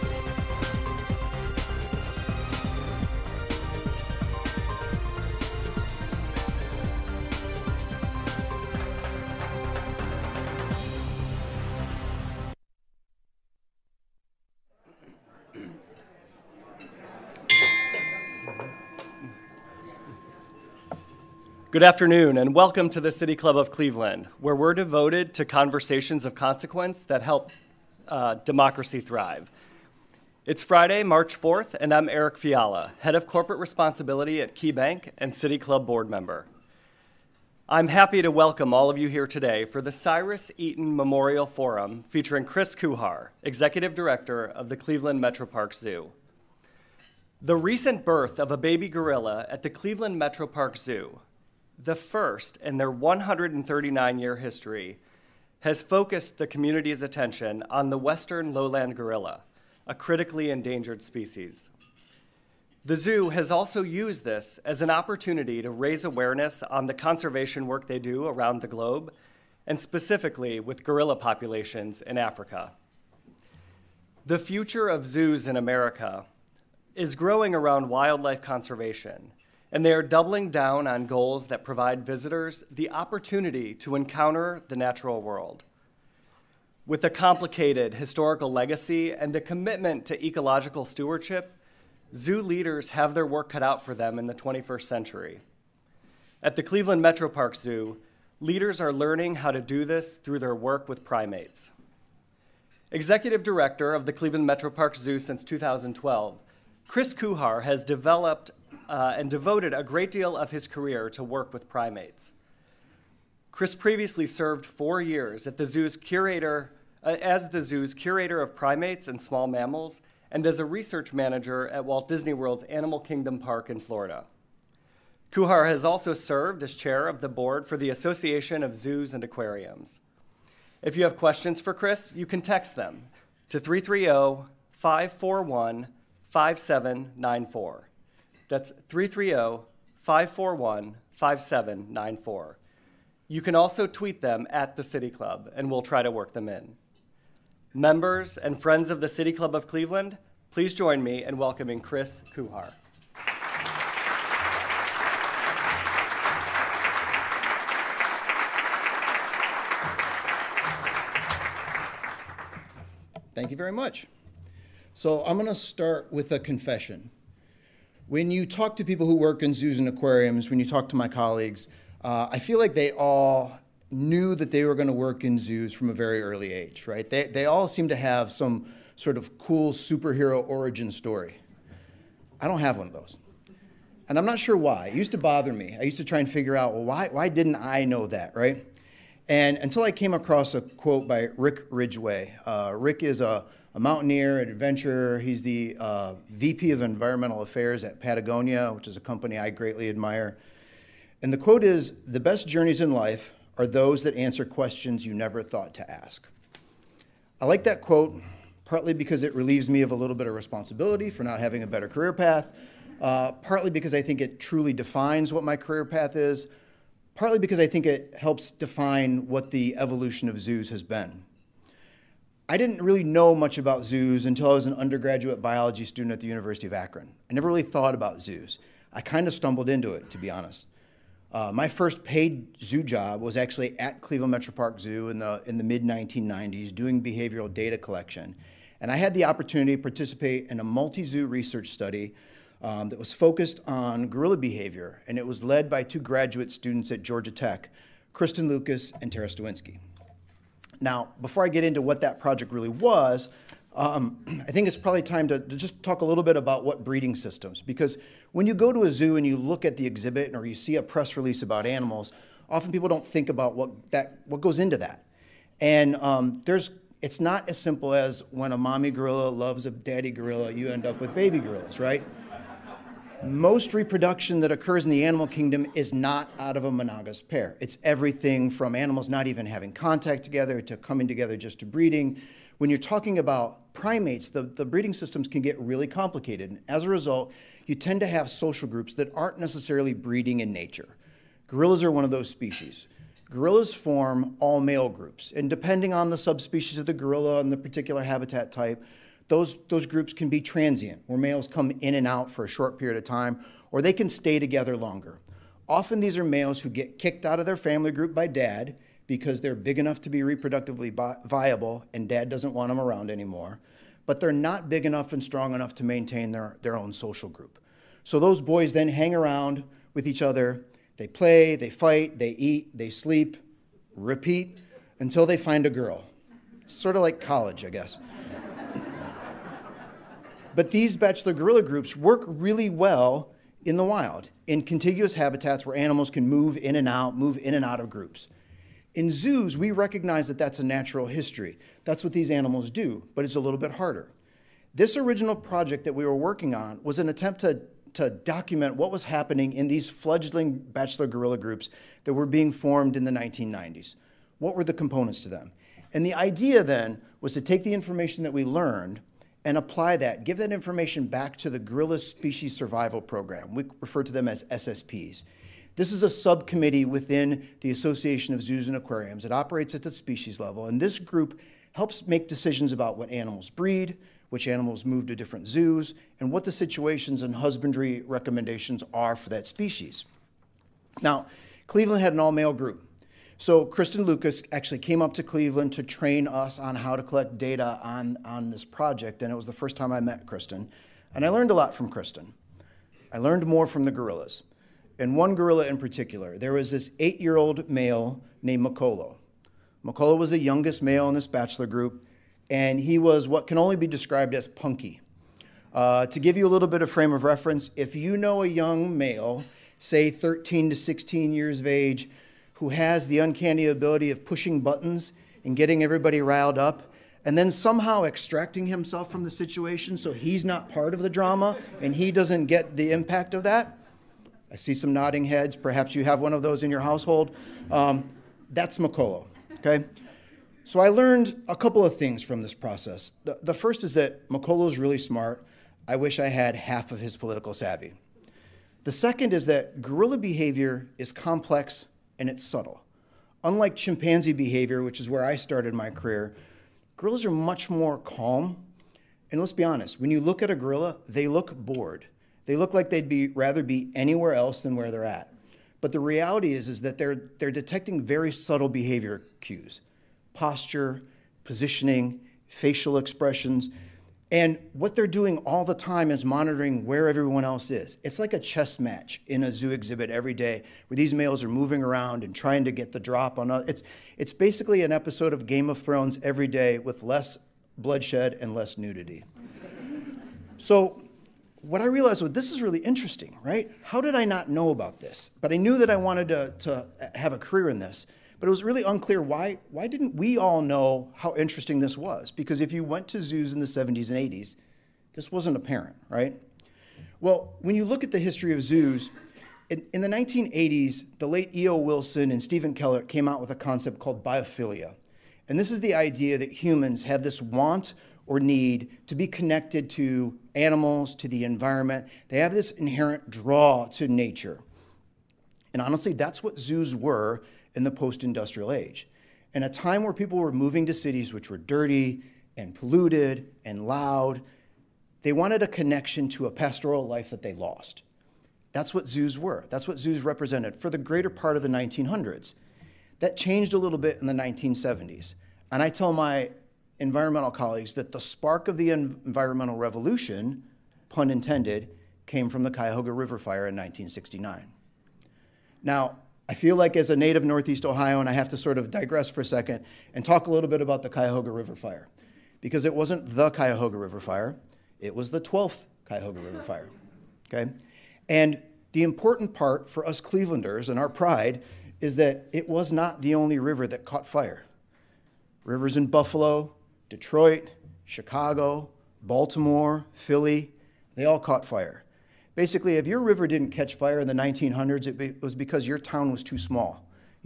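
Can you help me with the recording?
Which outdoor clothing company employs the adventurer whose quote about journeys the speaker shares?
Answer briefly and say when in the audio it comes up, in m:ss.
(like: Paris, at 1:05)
Patagonia, at 3:18.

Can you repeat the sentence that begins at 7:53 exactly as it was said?
It's, it's basically an episode of Game of Thrones every day with less bloodshed and less nudity.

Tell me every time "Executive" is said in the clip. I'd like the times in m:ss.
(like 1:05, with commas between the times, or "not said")
0:43, 1:42.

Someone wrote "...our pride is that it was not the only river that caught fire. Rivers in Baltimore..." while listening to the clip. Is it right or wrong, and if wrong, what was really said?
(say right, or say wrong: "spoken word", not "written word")
wrong: "Buffalo", not "Baltimore".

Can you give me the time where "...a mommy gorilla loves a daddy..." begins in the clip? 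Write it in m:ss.
4:28.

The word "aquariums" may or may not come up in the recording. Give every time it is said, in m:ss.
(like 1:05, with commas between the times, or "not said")
2:09, 2:49, 6:08.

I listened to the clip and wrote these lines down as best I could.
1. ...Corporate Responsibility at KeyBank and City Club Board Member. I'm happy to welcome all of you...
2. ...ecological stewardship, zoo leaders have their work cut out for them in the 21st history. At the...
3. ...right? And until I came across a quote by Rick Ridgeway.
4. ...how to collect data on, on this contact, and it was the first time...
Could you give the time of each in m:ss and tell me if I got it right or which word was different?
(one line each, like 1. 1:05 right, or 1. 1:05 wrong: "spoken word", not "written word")
1. 0:33 right
2. 1:30 wrong: "century", not "history"
3. 3:08 right
4. 6:26 wrong: "project", not "contact".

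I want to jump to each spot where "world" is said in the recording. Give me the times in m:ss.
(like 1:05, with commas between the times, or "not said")
1:25, 2:02.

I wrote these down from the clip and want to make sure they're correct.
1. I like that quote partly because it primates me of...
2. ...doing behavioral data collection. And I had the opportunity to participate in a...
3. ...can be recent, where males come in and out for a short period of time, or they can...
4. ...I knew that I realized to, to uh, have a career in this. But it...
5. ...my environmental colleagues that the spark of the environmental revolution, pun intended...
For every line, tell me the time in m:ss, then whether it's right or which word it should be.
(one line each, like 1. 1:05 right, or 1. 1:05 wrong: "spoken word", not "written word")
1. 3:27 wrong: "relieves", not "primates"
2. 3:56 right
3. 5:00 wrong: "transient", not "recent"
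4. 8:05 wrong: "wanted", not "realized"
5. 8:56 right.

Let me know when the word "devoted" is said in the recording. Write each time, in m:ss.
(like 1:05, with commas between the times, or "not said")
0:24, 1:49.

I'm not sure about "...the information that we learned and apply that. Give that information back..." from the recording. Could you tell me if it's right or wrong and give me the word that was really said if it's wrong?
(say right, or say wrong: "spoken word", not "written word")
right.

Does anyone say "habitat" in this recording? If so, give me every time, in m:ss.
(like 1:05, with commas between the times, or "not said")
4:58, 5:35.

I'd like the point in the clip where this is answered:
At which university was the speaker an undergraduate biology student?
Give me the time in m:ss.
3:46.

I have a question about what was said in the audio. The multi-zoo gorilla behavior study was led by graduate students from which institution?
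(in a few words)
Georgia Tech.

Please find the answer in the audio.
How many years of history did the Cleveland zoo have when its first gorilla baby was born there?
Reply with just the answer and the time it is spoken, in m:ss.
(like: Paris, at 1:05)
139, at 0:52.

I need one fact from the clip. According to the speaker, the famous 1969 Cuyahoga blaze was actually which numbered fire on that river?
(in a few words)
12th.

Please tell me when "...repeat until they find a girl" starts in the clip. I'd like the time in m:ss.
5:23.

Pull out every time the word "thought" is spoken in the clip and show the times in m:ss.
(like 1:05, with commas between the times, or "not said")
3:25, 3:47.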